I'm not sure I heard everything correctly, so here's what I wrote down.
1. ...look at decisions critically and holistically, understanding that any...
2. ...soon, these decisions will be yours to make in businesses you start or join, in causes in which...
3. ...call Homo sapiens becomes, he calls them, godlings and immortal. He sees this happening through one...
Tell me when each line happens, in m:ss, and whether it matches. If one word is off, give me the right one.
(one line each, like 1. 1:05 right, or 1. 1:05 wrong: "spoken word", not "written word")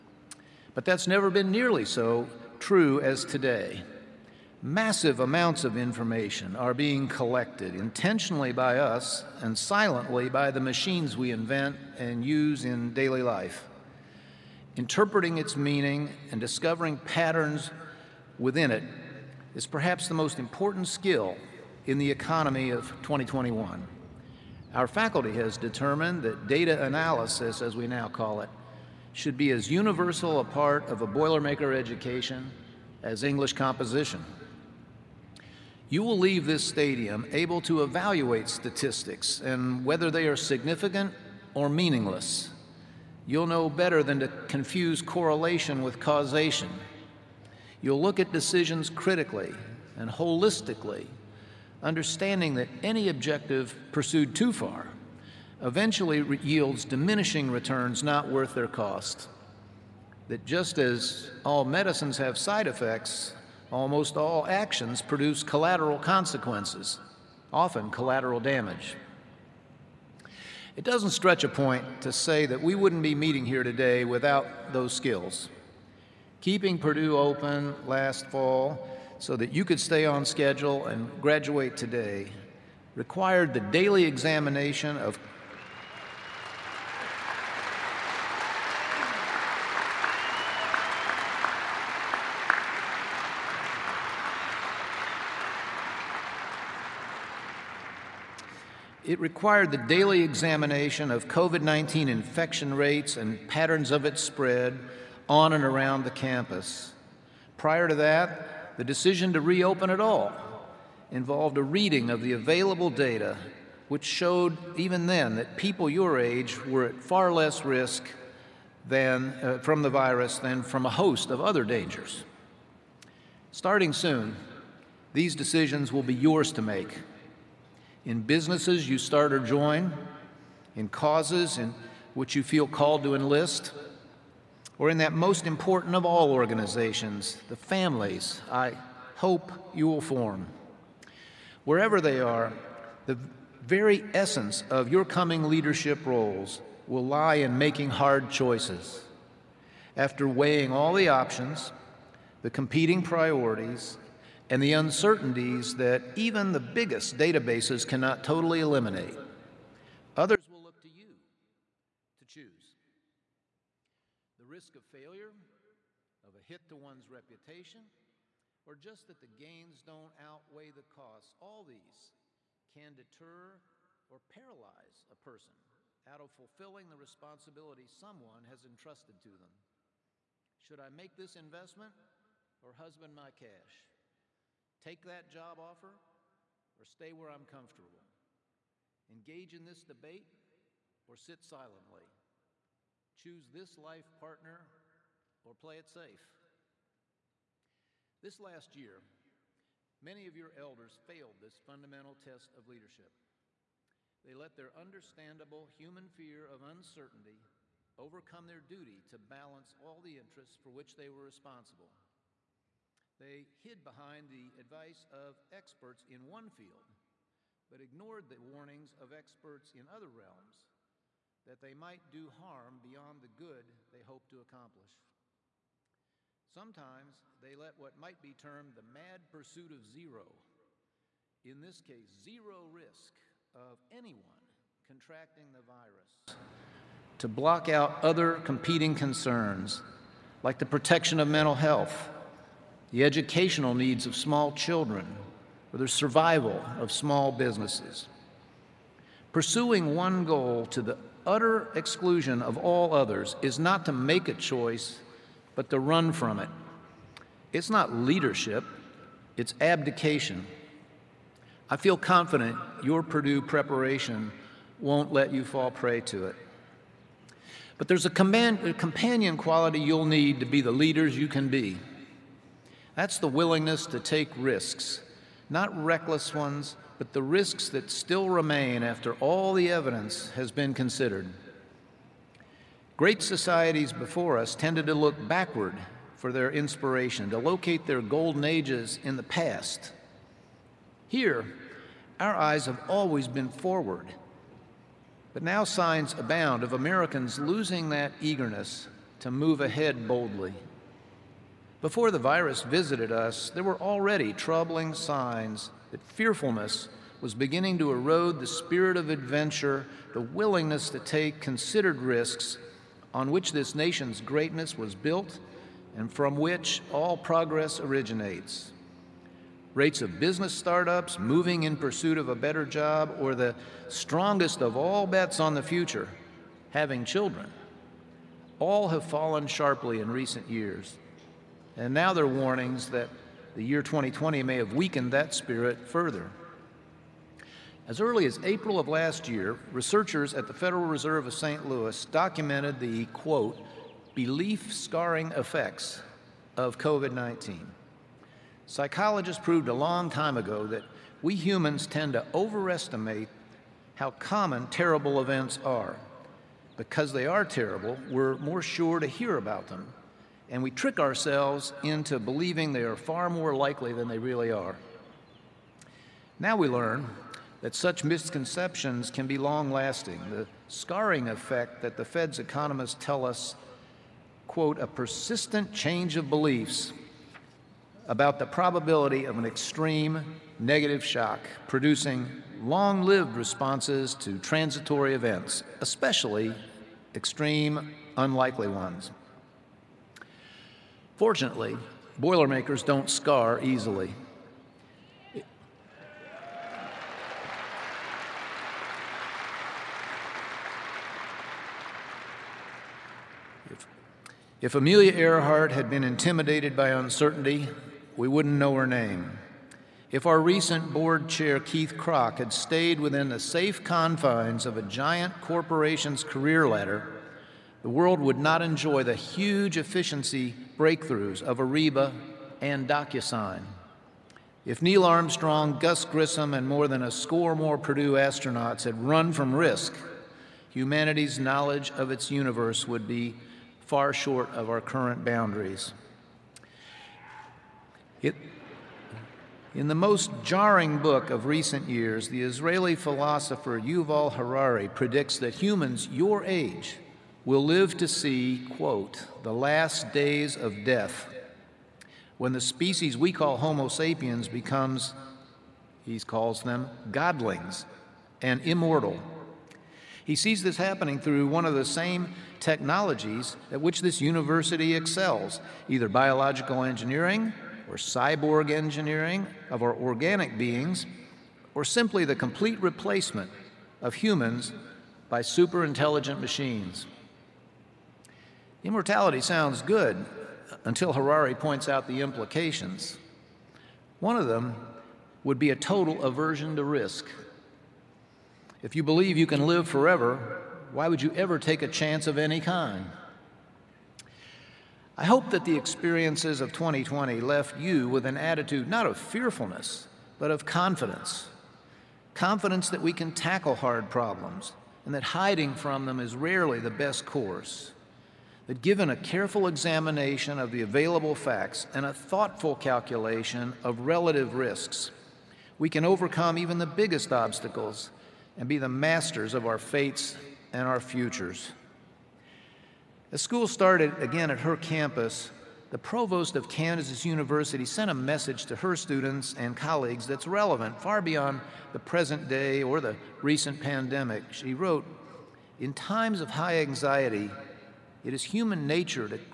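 1. 0:48 right
2. 2:03 right
3. 7:33 right.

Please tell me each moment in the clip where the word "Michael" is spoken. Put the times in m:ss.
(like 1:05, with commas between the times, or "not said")
not said.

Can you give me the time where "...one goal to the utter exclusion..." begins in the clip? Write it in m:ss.
4:09.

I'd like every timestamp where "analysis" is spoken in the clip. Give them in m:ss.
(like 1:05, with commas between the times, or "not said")
0:26.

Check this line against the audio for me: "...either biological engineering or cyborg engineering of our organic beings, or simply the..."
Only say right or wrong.
right.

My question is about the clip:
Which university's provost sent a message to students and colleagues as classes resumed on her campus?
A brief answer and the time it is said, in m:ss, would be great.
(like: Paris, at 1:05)
Kansas University, at 8:46.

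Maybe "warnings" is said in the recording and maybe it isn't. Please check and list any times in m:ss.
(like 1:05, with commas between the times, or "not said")
3:38, 5:32.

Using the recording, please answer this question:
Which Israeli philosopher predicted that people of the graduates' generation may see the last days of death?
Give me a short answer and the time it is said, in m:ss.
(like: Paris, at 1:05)
Yuval Harari, at 7:23.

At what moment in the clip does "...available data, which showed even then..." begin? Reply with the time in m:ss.
1:52.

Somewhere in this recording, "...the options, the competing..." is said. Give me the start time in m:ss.
2:30.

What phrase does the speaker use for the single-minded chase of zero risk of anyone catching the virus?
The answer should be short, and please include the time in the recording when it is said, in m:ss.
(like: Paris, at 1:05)
the mad pursuit of zero, at 3:48.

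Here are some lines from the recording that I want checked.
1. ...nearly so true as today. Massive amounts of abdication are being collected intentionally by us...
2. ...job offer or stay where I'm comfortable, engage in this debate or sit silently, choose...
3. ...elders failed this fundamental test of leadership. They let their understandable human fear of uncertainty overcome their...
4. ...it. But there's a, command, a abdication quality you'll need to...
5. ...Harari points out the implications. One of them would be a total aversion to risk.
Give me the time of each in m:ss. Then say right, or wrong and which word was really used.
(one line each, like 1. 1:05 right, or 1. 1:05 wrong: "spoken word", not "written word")
1. 0:01 wrong: "information", not "abdication"
2. 3:05 right
3. 3:20 right
4. 4:26 wrong: "companion", not "abdication"
5. 8:01 right.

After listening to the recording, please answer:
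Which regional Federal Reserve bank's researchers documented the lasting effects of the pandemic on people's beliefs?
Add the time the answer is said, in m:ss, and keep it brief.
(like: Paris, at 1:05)
St. Louis, at 5:41.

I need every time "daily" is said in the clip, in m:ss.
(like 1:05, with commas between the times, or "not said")
0:12, 1:23, 1:39.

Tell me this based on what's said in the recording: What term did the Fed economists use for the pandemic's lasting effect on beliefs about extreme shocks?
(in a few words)
belief scarring.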